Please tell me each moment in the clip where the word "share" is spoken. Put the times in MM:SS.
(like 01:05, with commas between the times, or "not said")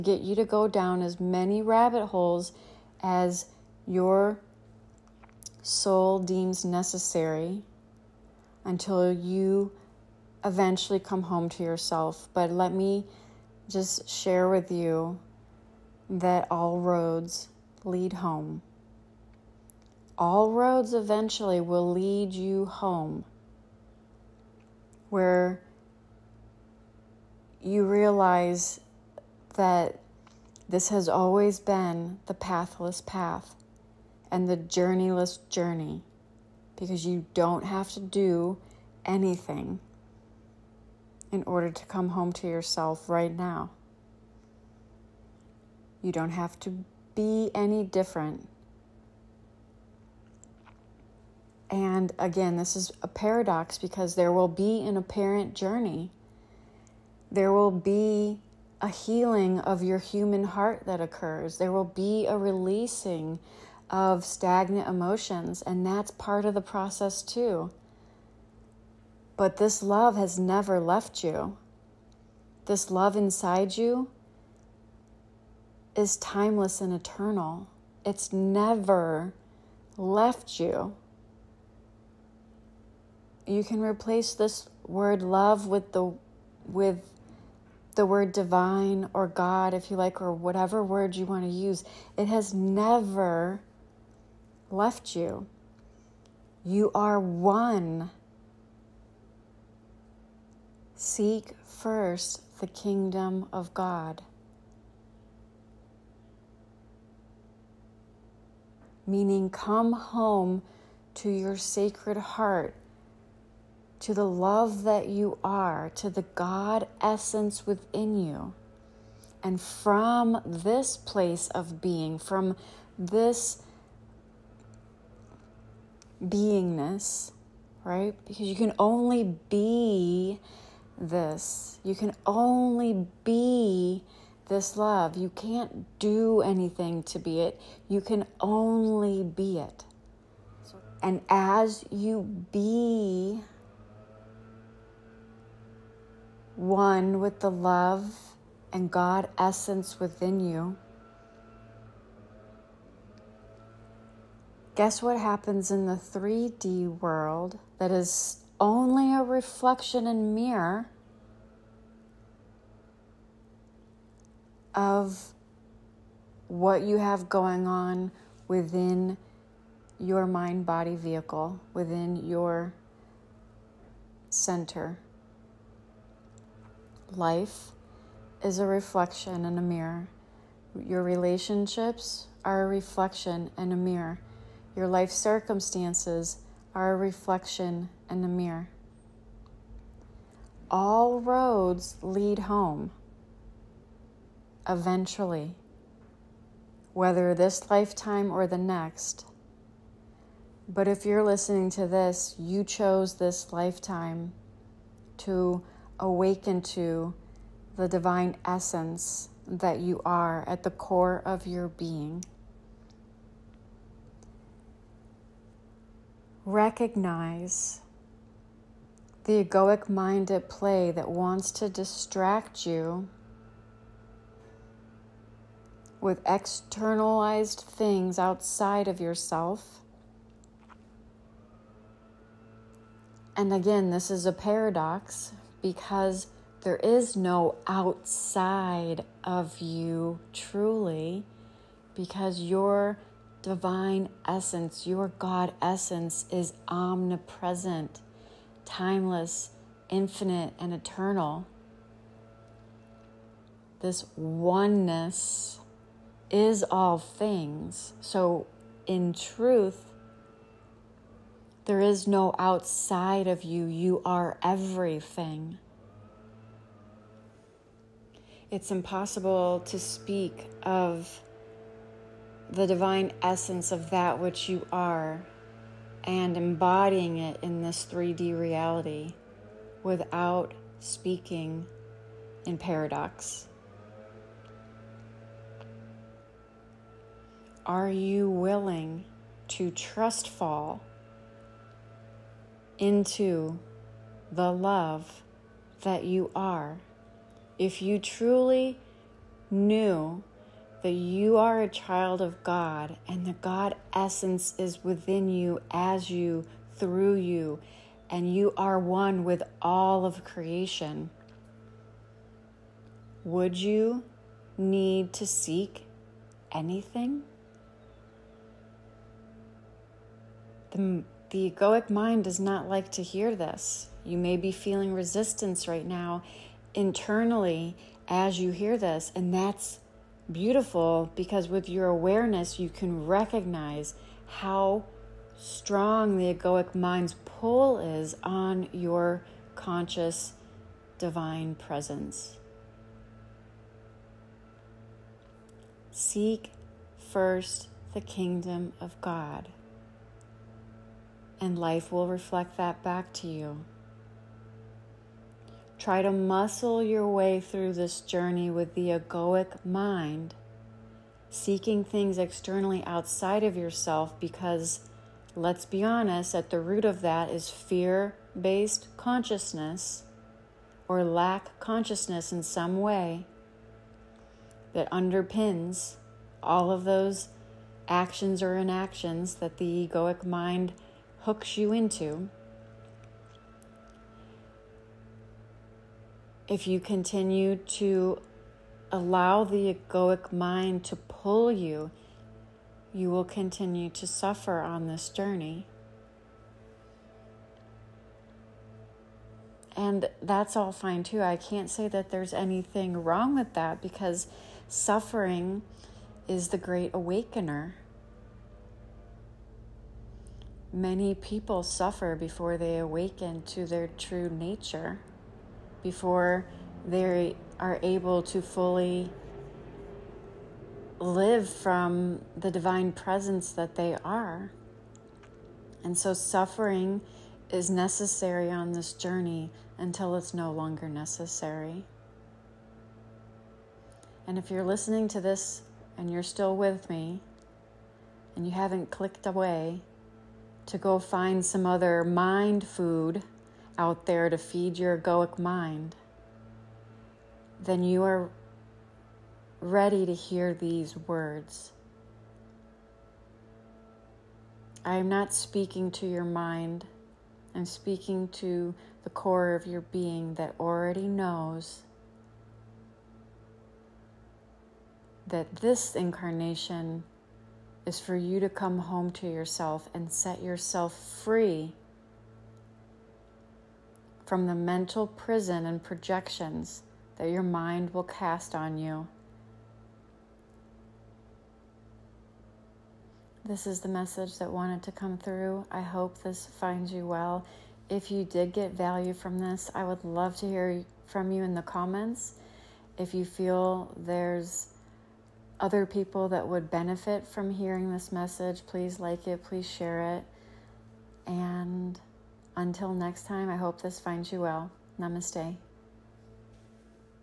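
00:14, 08:19.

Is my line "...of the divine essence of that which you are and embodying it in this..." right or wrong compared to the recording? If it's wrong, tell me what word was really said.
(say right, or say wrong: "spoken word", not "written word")
right.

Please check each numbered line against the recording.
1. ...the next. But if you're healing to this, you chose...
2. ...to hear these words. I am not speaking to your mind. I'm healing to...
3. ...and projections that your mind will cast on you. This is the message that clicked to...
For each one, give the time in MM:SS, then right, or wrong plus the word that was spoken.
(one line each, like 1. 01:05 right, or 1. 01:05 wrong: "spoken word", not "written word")
1. 03:18 wrong: "listening", not "healing"
2. 07:30 wrong: "speaking", not "healing"
3. 07:55 wrong: "wanted", not "clicked".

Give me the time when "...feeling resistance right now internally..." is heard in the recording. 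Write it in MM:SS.
05:24.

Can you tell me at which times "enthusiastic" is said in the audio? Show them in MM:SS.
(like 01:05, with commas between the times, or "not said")
not said.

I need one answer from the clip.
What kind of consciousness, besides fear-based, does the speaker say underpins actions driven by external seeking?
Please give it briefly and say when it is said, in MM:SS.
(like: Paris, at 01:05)
lack consciousness, at 06:11.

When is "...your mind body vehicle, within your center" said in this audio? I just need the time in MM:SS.
02:49.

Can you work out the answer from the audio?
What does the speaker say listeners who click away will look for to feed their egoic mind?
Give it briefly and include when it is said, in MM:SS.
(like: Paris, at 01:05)
mind food, at 07:22.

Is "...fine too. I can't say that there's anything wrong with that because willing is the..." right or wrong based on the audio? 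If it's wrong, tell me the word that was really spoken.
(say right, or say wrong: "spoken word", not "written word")
wrong: "suffering", not "willing".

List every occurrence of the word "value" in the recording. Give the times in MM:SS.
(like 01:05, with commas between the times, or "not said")
08:08.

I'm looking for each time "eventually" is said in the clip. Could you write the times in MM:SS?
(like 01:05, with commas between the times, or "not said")
00:10, 00:20, 03:14.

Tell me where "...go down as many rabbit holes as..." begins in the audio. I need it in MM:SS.
00:00.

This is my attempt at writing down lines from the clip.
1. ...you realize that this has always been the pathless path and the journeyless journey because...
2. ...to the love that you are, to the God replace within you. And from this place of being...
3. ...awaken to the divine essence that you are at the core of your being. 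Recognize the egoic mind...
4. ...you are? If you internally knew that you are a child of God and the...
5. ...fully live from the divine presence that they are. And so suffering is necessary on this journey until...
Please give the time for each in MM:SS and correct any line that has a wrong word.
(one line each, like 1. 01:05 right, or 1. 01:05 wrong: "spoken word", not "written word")
1. 00:27 right
2. 01:53 wrong: "essence", not "replace"
3. 03:25 right
4. 04:56 wrong: "truly", not "internally"
5. 06:58 right.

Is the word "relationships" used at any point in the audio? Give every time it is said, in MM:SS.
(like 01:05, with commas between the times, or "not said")
03:01.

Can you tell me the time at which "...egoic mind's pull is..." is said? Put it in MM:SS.
05:36.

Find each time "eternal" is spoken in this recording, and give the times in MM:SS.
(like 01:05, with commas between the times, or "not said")
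01:16, 04:10.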